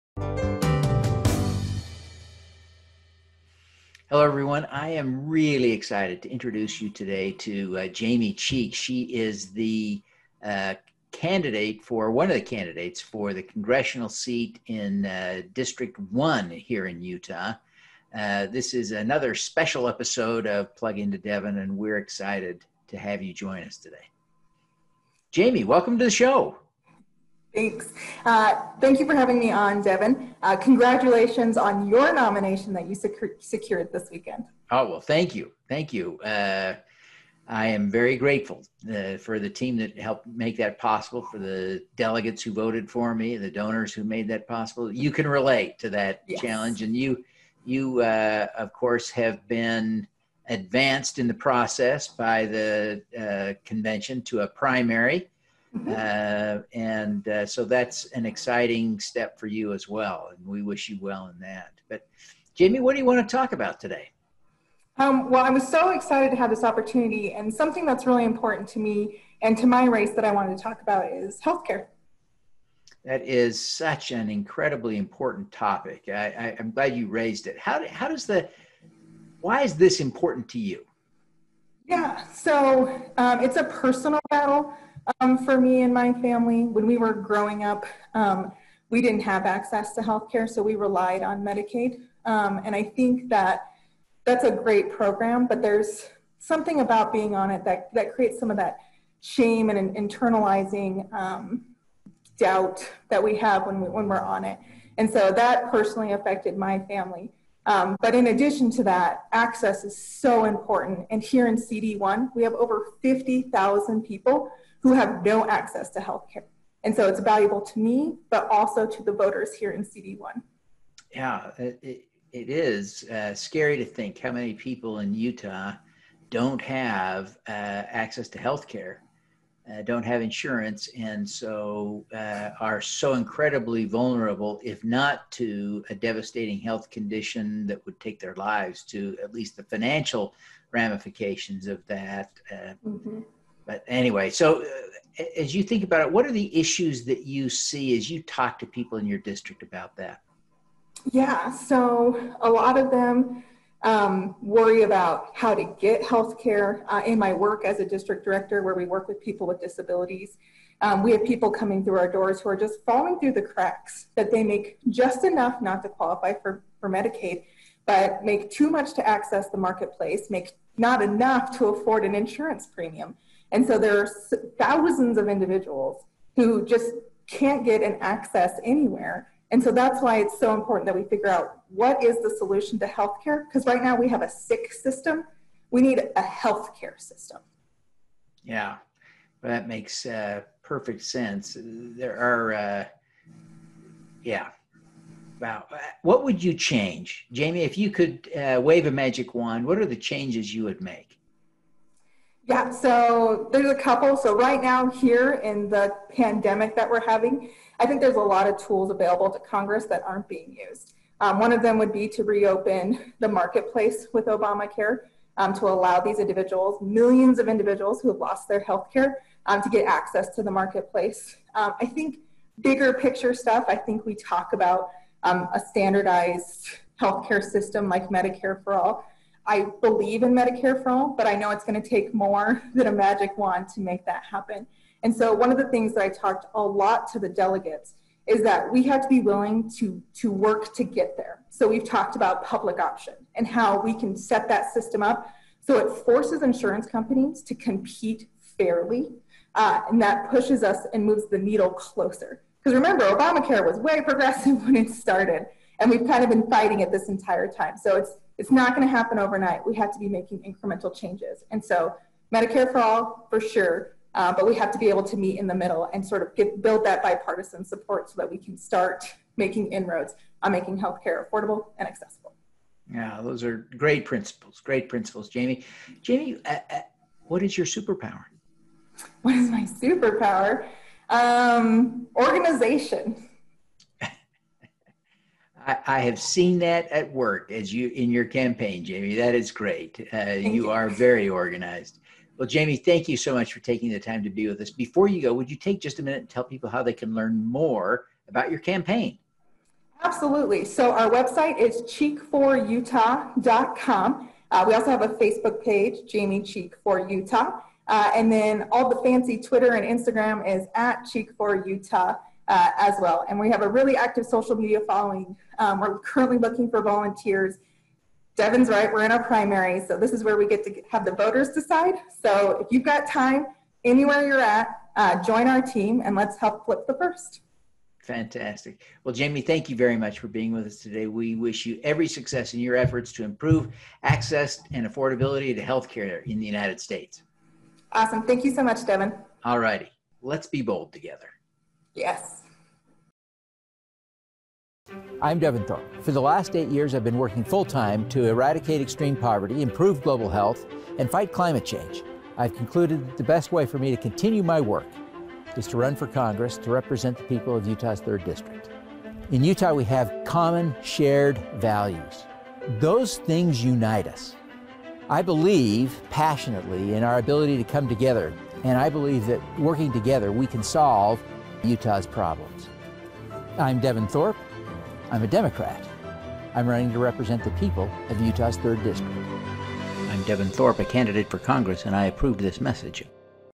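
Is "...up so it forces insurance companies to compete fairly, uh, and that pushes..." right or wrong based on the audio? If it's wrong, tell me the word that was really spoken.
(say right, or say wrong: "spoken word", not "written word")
right.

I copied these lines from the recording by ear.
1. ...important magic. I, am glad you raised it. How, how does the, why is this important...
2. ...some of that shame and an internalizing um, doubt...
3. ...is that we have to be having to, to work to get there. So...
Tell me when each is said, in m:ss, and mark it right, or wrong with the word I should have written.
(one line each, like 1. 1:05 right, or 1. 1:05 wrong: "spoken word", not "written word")
1. 1:14 wrong: "topic", not "magic"
2. 1:38 right
3. 3:58 wrong: "willing", not "having".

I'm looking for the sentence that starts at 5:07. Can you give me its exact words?
Uh, and then all the fancy Twitter and Instagram is at Cheek for Utah uh, as well.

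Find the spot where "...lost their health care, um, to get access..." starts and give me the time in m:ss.
3:38.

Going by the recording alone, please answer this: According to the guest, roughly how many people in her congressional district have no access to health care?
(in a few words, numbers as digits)
50,000.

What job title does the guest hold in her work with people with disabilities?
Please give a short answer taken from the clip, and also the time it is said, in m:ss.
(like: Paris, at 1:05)
district director, at 2:37.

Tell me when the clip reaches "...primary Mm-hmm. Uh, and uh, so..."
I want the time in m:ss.
0:54.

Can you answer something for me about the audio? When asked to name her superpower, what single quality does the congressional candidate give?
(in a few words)
organization.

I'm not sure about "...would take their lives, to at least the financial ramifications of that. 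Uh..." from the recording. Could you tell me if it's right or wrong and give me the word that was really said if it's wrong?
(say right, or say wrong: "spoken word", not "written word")
right.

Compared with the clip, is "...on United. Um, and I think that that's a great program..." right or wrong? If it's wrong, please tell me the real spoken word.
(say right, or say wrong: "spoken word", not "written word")
wrong: "Medicaid", not "United".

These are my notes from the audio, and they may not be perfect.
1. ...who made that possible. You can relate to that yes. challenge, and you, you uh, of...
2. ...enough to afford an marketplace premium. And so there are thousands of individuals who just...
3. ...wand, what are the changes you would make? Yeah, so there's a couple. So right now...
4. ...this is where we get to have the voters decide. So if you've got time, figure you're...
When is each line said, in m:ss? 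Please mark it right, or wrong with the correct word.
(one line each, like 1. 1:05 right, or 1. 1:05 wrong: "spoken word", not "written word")
1. 0:43 right
2. 2:51 wrong: "insurance", not "marketplace"
3. 3:19 right
4. 5:19 wrong: "anywhere", not "figure".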